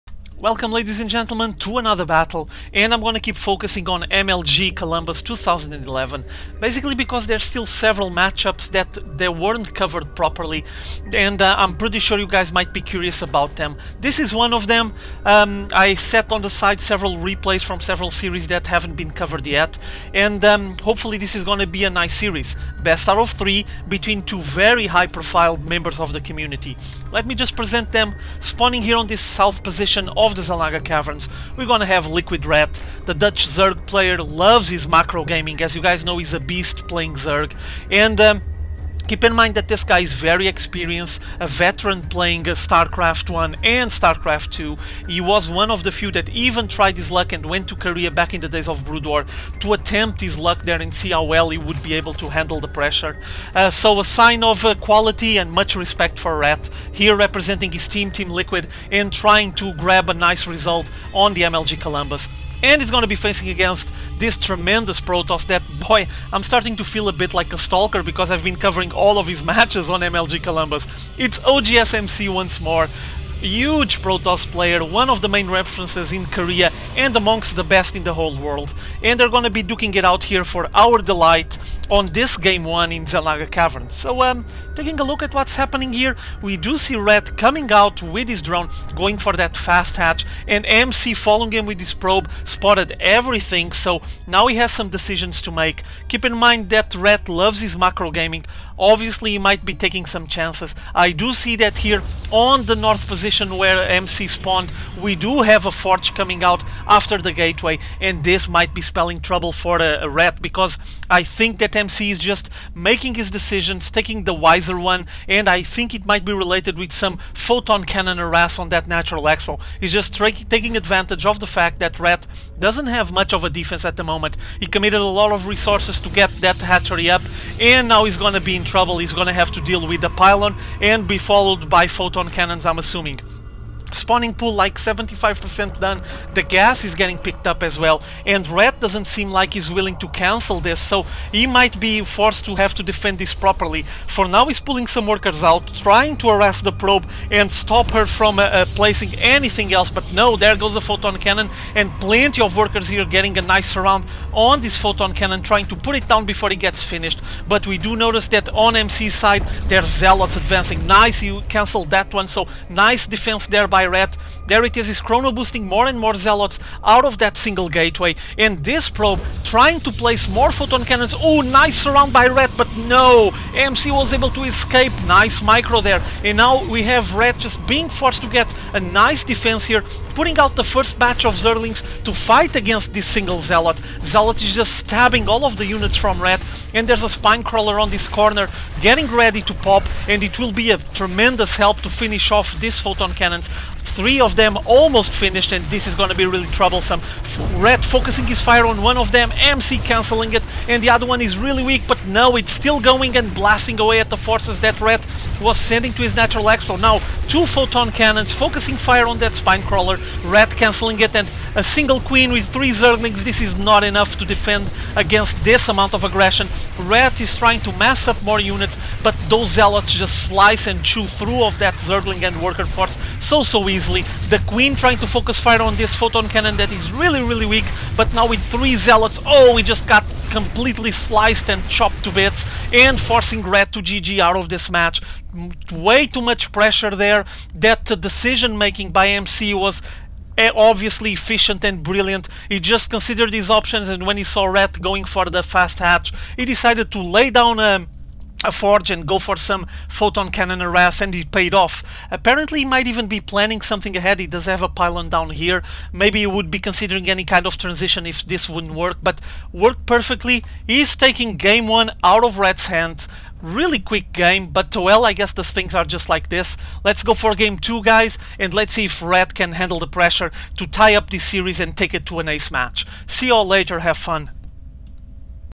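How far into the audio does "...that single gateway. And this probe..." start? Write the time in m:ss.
2:47.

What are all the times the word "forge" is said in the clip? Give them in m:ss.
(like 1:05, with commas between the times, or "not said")
1:45, 4:08.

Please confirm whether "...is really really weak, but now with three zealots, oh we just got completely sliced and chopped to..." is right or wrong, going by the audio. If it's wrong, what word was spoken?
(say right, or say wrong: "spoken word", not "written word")
right.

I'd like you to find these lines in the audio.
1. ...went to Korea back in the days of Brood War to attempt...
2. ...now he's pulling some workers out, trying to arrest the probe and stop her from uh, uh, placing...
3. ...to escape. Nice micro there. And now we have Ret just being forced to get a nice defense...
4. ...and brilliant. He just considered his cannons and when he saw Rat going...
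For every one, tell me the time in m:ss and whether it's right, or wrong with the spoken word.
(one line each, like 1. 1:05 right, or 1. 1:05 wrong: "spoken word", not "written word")
1. 0:47 right
2. 2:24 right
3. 2:54 right
4. 4:01 wrong: "options", not "cannons".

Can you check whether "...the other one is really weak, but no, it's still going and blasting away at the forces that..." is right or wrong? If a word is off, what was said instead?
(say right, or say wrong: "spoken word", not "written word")
right.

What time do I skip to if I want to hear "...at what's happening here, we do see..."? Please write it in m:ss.
1:25.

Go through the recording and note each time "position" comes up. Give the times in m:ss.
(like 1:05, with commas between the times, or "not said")
0:29, 1:43.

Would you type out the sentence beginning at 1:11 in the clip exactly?
It's OGSMC once more, huge Protoss player, one of the main references in Korea and amongst the best in the whole world.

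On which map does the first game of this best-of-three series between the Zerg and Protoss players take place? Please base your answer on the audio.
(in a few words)
Xel'Naga Caverns.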